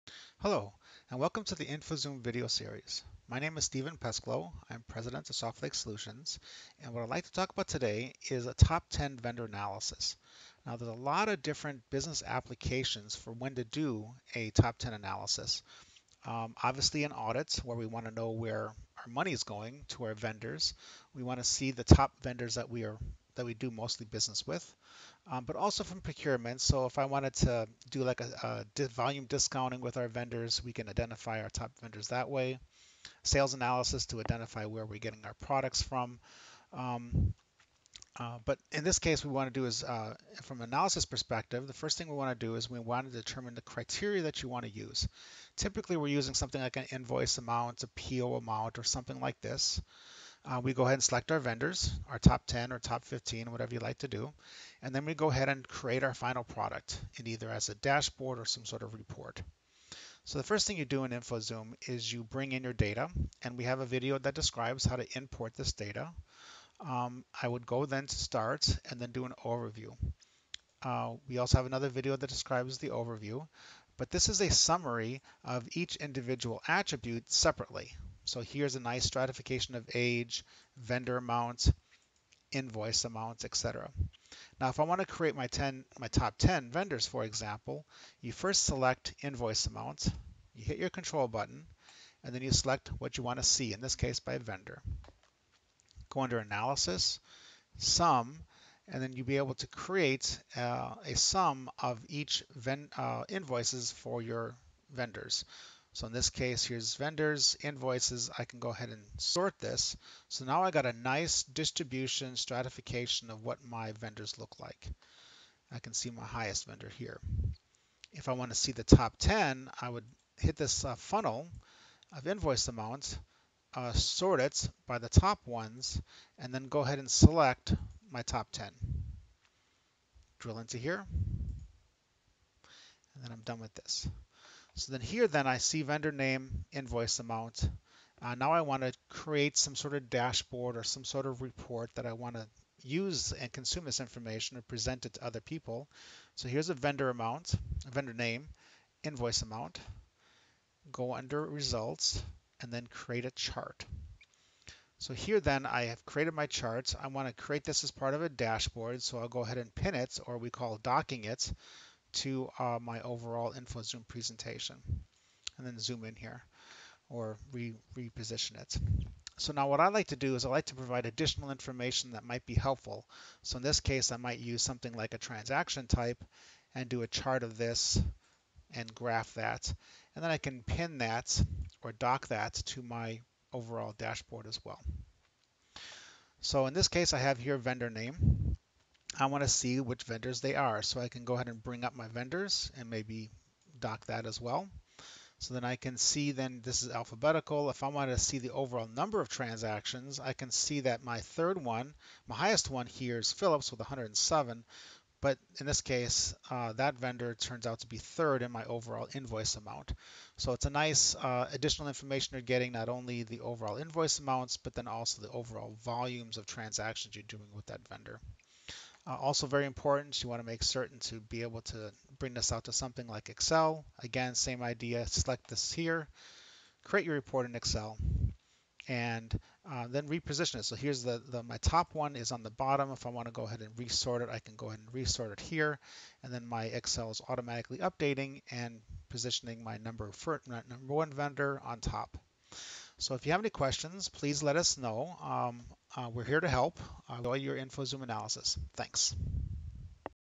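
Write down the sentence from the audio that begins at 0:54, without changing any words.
And then we go ahead and create our final product in either as a dashboard or some sort of report.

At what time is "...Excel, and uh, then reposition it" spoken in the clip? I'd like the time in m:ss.
3:47.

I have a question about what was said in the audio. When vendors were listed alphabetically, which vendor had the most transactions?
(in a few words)
Phillips.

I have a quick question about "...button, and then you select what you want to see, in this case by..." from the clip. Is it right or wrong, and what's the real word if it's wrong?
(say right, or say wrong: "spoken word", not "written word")
right.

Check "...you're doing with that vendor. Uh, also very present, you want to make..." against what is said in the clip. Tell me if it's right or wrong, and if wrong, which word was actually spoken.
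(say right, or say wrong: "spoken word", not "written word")
wrong: "important", not "present".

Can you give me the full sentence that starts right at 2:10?
Drill into here, and then I'm done with this.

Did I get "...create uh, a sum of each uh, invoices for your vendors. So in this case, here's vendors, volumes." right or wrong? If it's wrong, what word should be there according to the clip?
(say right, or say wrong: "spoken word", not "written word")
wrong: "invoices", not "volumes".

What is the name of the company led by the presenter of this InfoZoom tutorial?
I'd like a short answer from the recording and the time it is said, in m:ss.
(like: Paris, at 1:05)
Softlake Solutions, at 0:05.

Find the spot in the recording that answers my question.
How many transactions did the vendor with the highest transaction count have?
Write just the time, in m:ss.
3:23.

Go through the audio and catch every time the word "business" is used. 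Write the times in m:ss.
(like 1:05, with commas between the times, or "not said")
0:11, 0:24.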